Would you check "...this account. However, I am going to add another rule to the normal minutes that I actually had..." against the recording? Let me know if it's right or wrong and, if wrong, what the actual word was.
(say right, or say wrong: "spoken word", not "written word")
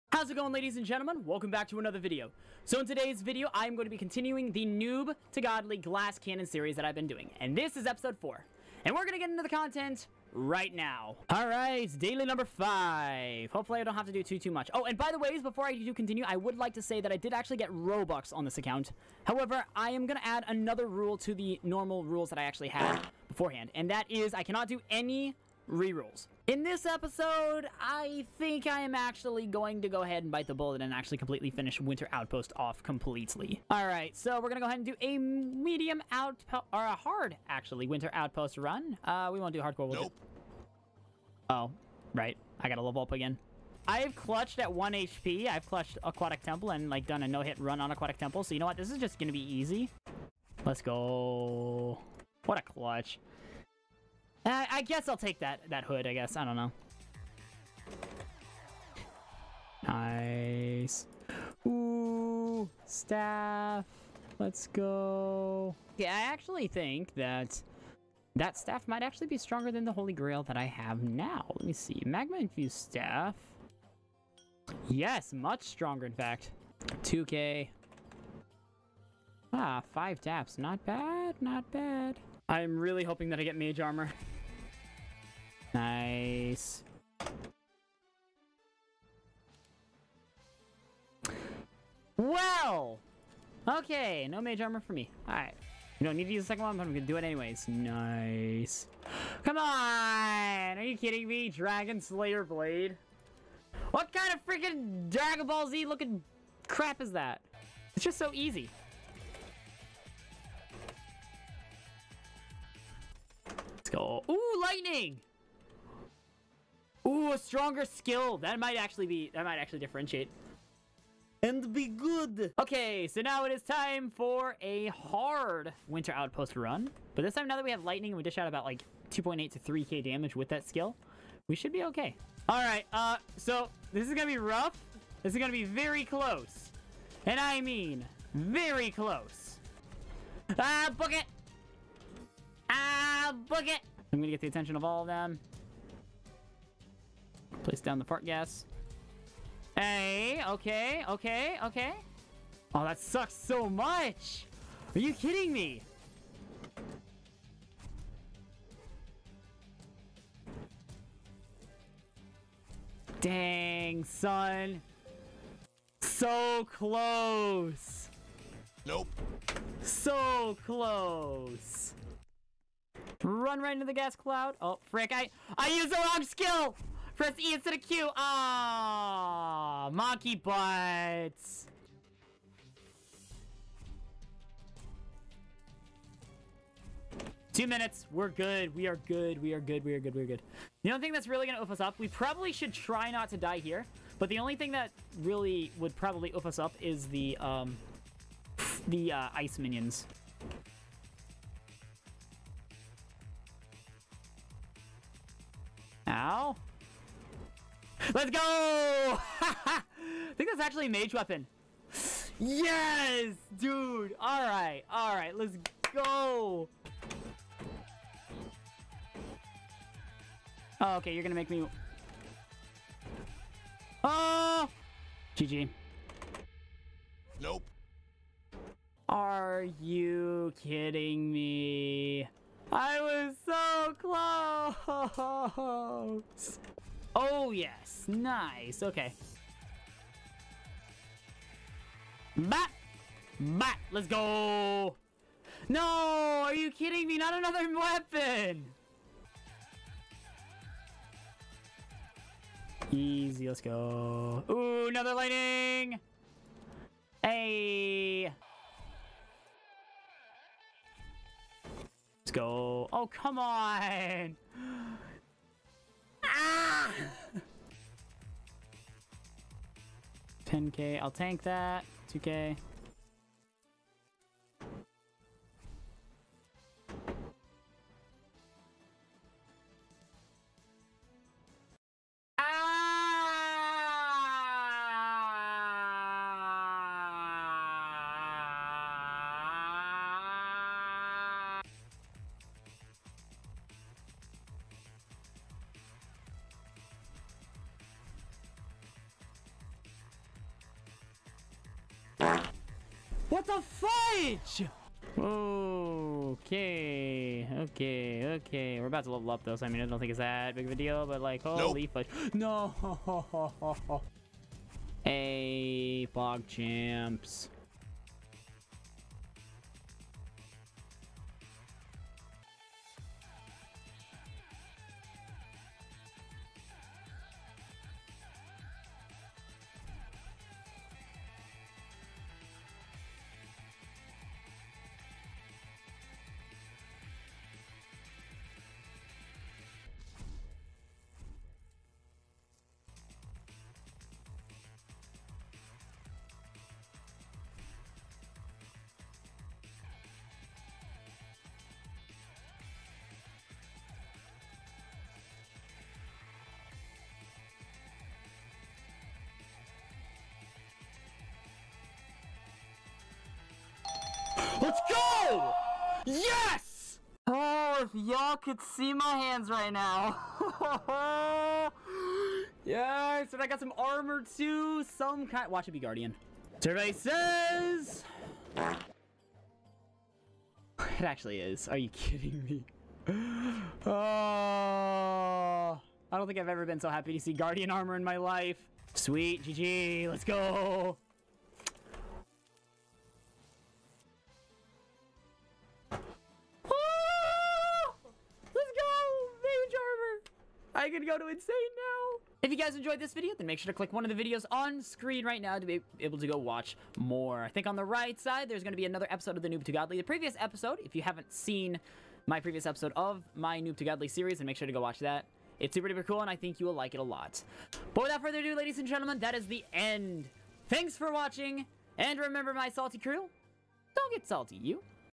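wrong: "rules", not "minutes".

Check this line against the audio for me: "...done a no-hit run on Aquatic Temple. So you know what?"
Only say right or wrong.
right.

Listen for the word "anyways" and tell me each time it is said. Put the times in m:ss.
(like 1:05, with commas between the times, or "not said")
1:37.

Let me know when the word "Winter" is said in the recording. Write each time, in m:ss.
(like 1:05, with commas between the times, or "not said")
0:31, 0:37, 2:05.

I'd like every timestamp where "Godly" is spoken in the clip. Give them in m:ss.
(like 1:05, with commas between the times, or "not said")
0:05, 6:49, 6:53.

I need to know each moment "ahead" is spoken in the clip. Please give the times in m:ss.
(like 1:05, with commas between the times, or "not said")
0:30, 0:34.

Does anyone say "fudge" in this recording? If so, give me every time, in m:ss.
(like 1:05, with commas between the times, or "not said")
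5:03, 5:11.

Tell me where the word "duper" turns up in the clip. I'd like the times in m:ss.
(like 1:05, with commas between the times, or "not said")
6:55.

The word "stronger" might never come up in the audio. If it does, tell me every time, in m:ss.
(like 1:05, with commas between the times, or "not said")
1:09, 1:15, 1:57.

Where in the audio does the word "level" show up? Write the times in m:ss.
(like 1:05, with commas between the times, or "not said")
0:42, 5:09.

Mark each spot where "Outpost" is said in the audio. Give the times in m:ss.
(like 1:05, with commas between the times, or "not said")
0:32, 0:38, 2:06.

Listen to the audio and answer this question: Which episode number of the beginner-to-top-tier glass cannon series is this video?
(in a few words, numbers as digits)
4.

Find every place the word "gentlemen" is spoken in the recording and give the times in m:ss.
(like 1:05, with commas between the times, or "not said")
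0:00, 6:58.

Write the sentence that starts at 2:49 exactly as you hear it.
So close run right into the gas cloud.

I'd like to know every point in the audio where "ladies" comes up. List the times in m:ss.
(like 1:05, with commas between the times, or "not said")
0:00, 6:58.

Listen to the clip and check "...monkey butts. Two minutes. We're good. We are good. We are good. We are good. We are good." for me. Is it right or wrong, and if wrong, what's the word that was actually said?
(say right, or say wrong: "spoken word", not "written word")
right.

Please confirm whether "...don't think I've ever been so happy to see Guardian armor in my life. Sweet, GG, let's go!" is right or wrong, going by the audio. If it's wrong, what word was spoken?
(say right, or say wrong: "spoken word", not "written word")
right.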